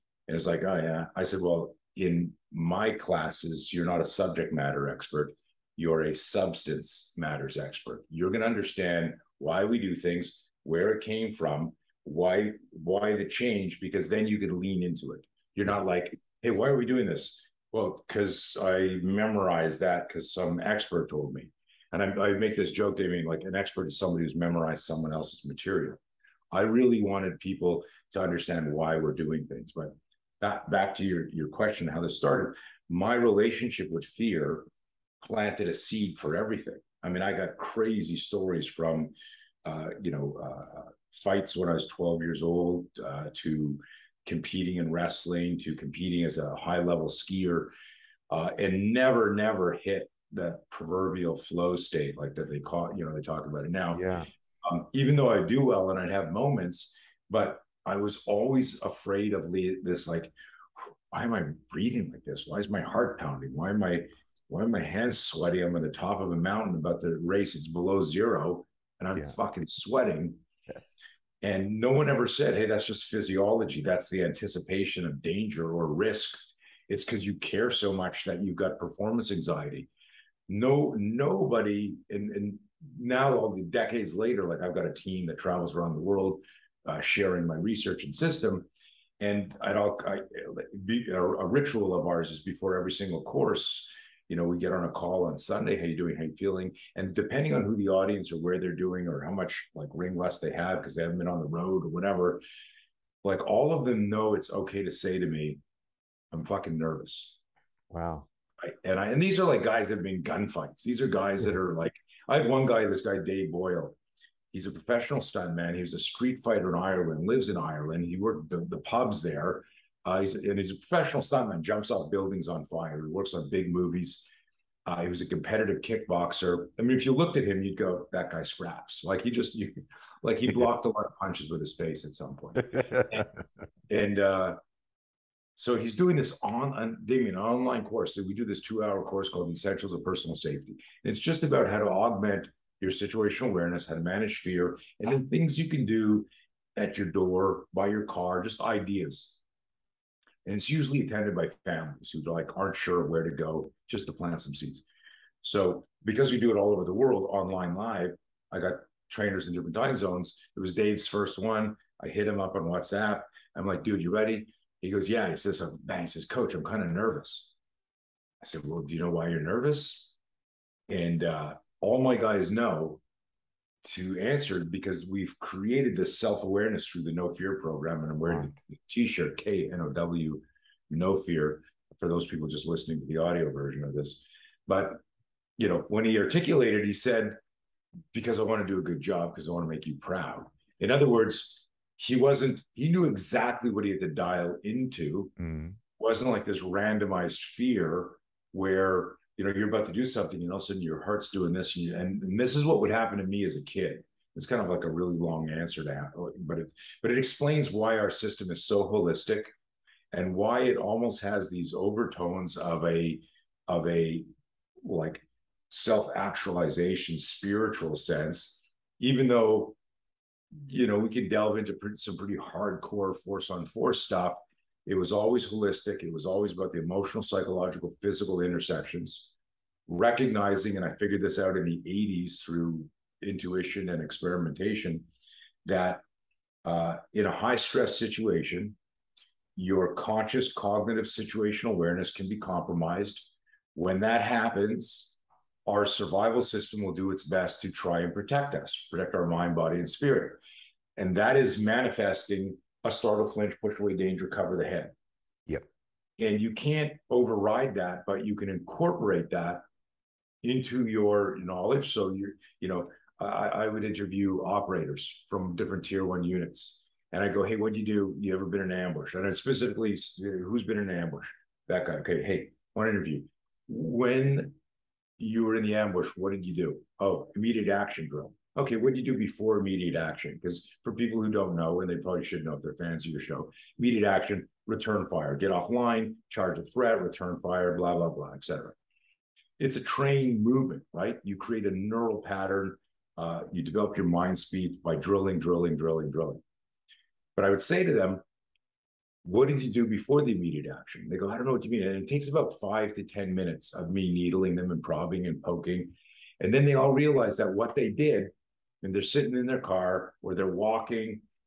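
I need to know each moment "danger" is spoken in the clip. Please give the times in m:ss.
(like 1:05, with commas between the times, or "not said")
1:15, 4:13.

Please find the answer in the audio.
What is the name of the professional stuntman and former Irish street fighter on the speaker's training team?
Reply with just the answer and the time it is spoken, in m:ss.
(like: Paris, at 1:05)
Dave Boyle, at 1:53.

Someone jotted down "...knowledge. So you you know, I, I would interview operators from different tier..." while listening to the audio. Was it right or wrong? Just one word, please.
right.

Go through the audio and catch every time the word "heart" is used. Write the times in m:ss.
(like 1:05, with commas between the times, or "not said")
1:02, 3:21.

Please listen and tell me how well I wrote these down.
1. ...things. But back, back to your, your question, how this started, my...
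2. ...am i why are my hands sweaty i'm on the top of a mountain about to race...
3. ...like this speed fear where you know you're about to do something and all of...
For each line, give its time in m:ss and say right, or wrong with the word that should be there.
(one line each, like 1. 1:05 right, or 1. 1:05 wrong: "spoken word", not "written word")
1. 0:29 right
2. 1:03 right
3. 3:16 wrong: "randomized", not "speed".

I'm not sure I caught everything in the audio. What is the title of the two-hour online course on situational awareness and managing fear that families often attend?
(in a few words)
Essentials of Personal Safety.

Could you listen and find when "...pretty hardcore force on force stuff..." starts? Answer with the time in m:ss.
3:42.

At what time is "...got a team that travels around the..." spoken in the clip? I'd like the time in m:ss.
1:24.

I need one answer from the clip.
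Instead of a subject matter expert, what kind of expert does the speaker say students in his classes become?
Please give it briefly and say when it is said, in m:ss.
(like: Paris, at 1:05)
Substance matters expert, at 0:06.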